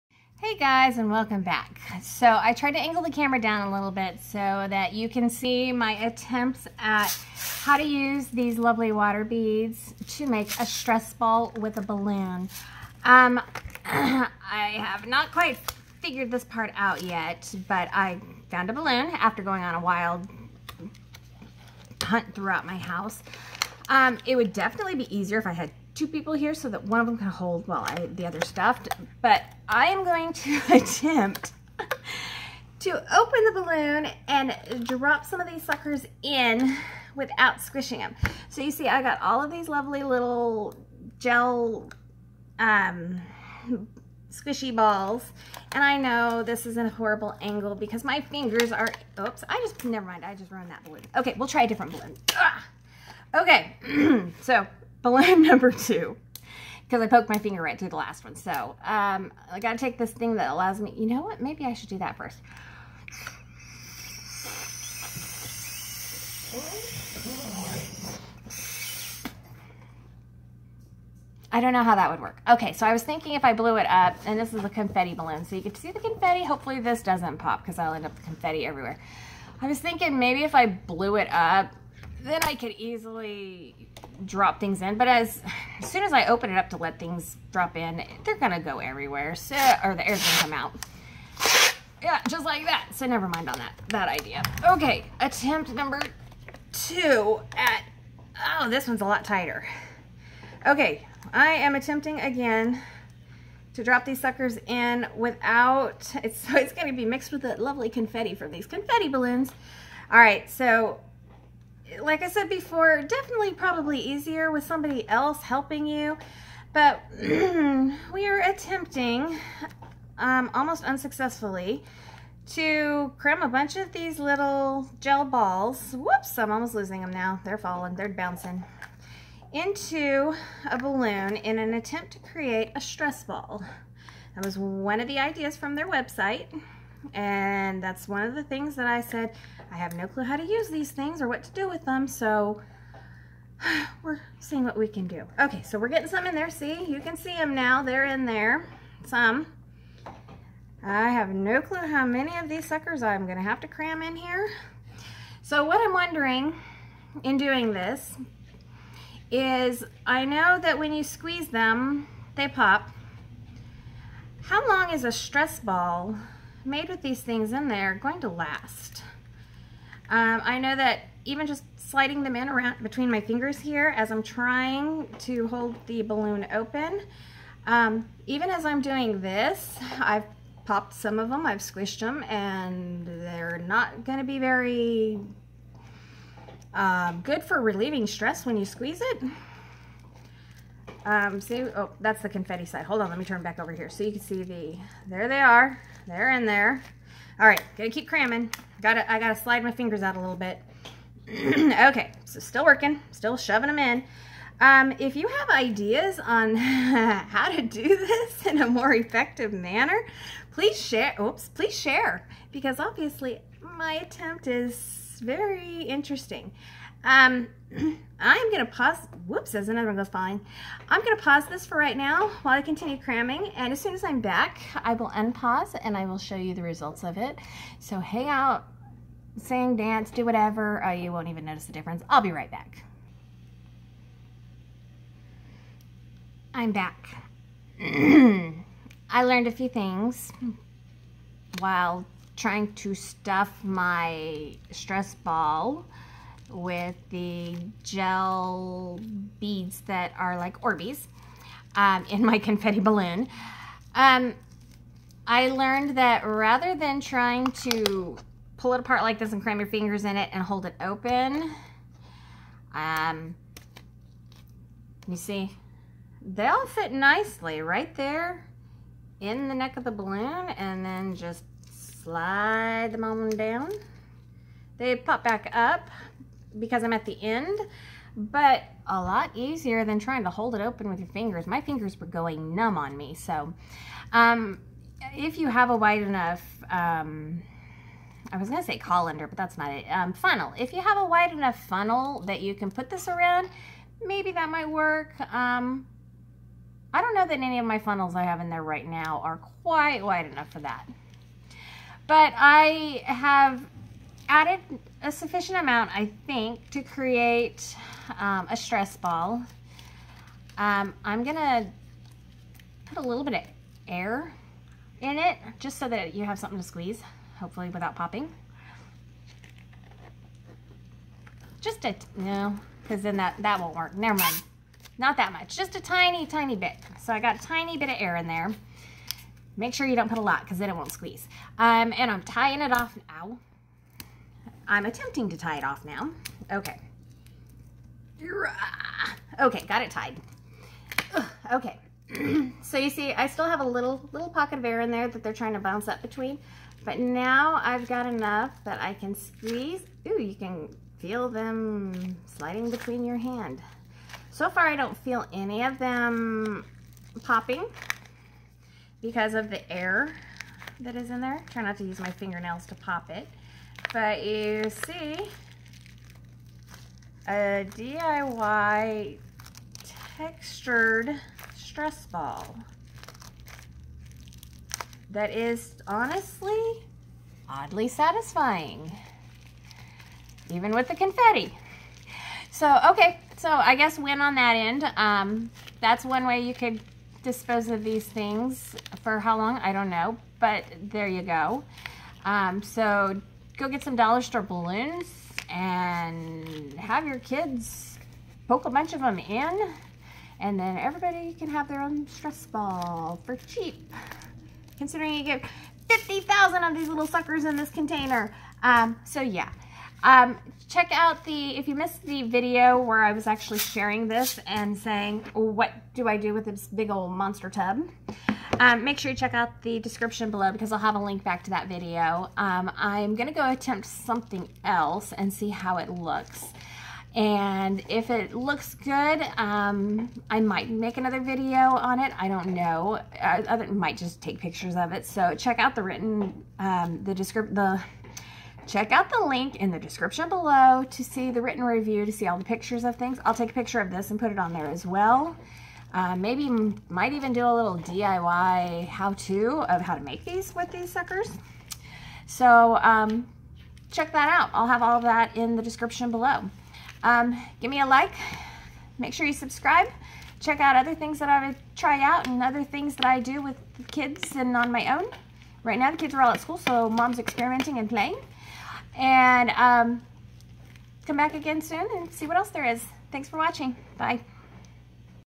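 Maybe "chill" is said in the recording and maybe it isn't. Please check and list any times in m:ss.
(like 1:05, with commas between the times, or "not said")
not said.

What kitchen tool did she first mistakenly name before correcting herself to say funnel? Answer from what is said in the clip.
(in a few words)
colander.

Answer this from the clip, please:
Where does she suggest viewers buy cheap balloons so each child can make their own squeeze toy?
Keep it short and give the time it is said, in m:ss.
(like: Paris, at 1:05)
dollar store, at 6:33.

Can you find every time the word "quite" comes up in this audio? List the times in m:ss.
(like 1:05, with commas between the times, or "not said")
0:15, 4:59.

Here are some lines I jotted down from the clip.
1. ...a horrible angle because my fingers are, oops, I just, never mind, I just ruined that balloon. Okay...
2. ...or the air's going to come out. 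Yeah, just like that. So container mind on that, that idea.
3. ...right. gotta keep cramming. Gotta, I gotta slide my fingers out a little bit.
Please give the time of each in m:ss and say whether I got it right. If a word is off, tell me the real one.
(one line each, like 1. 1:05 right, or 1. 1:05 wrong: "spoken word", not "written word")
1. 0:46 right
2. 1:29 wrong: "never", not "container"
3. 3:17 right.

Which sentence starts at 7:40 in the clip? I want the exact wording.
Check out other things that I would try out and other things that I do with kids and on my own.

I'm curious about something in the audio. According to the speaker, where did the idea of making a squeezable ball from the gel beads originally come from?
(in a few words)
their website.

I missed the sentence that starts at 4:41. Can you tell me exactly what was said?
My fingers were going numb on me.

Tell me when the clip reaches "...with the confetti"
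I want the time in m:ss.
6:20.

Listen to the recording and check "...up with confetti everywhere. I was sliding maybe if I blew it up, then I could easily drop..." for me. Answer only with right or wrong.
wrong.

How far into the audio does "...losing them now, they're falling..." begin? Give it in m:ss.
2:06.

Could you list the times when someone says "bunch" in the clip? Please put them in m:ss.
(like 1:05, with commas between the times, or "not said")
2:03, 6:38.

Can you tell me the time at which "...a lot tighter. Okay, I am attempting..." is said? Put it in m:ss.
1:39.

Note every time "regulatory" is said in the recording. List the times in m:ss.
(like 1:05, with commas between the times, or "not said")
not said.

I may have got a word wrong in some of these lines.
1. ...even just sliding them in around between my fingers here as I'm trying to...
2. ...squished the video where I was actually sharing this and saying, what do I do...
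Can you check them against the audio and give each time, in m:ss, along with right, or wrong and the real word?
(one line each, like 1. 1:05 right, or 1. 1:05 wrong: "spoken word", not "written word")
1. 2:51 right
2. 6:51 wrong: "missed", not "squished".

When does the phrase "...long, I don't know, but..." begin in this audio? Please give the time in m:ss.
6:29.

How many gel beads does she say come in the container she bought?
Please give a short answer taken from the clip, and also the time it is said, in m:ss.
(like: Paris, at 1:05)
50,000, at 6:45.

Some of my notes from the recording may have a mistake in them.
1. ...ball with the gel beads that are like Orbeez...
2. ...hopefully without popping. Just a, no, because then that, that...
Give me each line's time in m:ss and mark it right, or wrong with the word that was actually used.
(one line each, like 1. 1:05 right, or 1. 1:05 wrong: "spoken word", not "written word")
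1. 4:05 right
2. 5:17 right.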